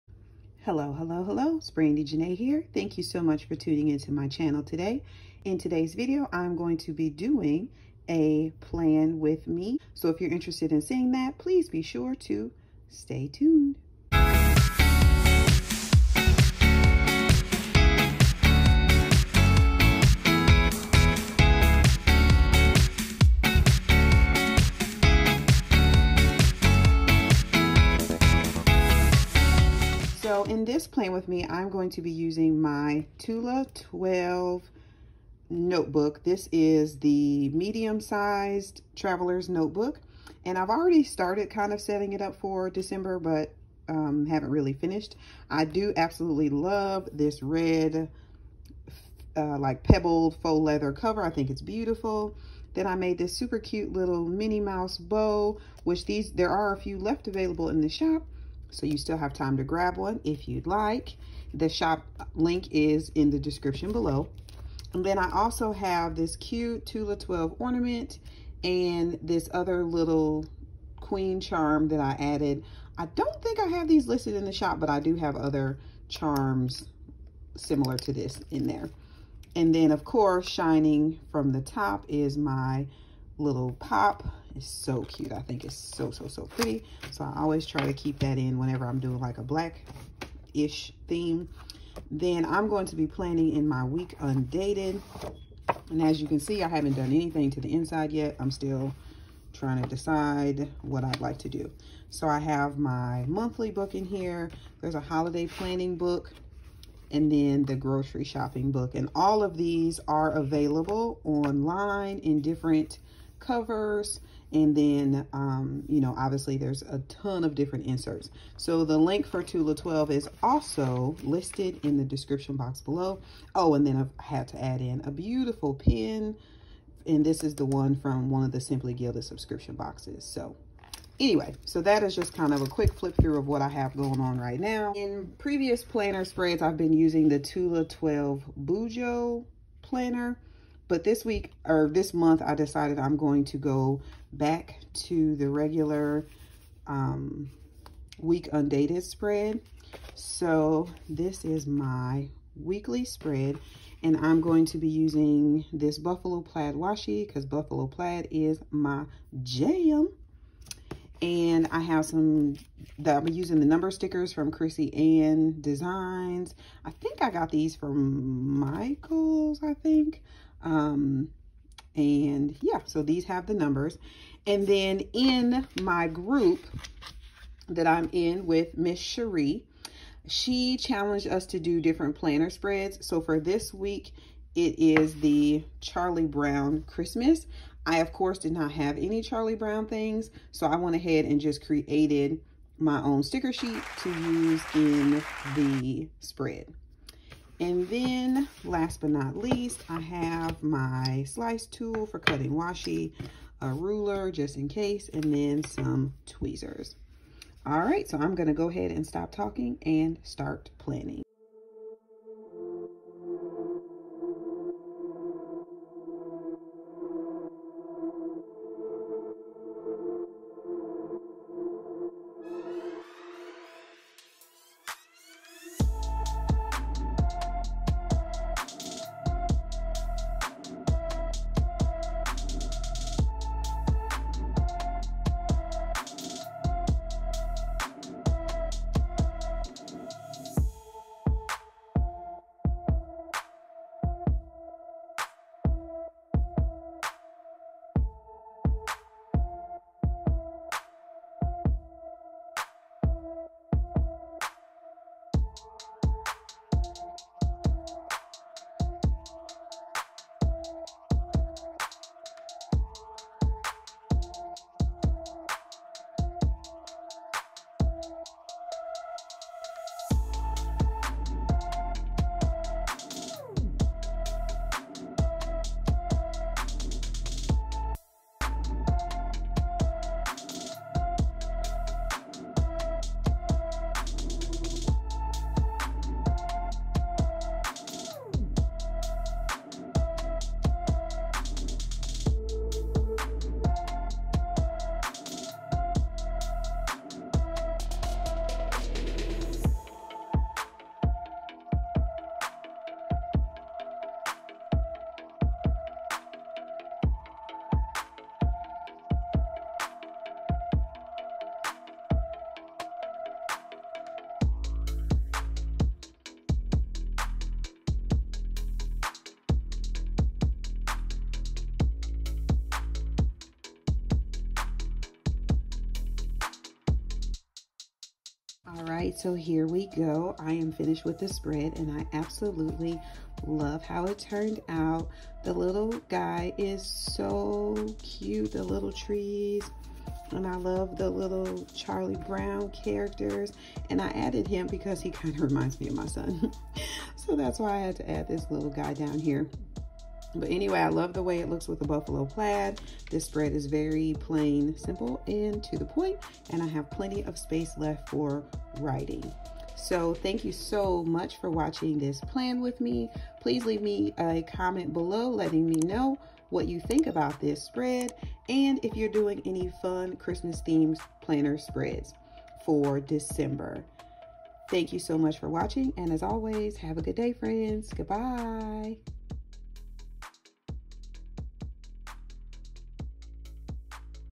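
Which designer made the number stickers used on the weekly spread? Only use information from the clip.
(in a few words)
Chrissy Ann Designs.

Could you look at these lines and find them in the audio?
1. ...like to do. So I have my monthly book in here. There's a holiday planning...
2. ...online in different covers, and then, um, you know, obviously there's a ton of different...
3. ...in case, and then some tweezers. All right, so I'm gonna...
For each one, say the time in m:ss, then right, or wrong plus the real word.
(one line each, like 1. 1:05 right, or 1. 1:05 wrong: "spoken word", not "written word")
1. 1:41 right
2. 1:51 right
3. 3:24 right.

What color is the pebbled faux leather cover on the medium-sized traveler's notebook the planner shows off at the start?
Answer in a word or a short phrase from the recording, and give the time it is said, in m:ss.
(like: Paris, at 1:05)
Red, at 0:47.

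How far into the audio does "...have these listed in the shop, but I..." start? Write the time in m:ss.
1:13.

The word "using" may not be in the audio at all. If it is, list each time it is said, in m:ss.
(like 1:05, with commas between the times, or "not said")
0:32, 2:16, 2:34, 2:43.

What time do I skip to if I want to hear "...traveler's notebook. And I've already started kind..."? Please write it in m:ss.
0:38.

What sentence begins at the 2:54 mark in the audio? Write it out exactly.
And then in my group that I'm in with Miss Cherie, she challenged us to do different planner spreads.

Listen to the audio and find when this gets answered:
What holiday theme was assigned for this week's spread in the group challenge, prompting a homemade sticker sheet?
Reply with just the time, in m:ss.
3:05.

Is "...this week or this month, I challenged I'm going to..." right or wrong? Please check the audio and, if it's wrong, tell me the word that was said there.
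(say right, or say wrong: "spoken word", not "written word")
wrong: "decided", not "challenged".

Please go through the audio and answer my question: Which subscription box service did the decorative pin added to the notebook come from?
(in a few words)
Simply Gilded.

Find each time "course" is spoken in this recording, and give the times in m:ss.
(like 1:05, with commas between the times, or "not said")
1:20, 3:08.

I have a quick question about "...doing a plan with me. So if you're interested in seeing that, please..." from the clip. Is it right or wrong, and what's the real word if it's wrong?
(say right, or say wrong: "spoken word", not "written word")
right.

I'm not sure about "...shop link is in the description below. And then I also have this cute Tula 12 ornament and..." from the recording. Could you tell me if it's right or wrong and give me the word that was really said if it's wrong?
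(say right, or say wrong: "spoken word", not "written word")
right.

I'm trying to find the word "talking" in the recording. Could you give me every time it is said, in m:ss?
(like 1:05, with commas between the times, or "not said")
3:29.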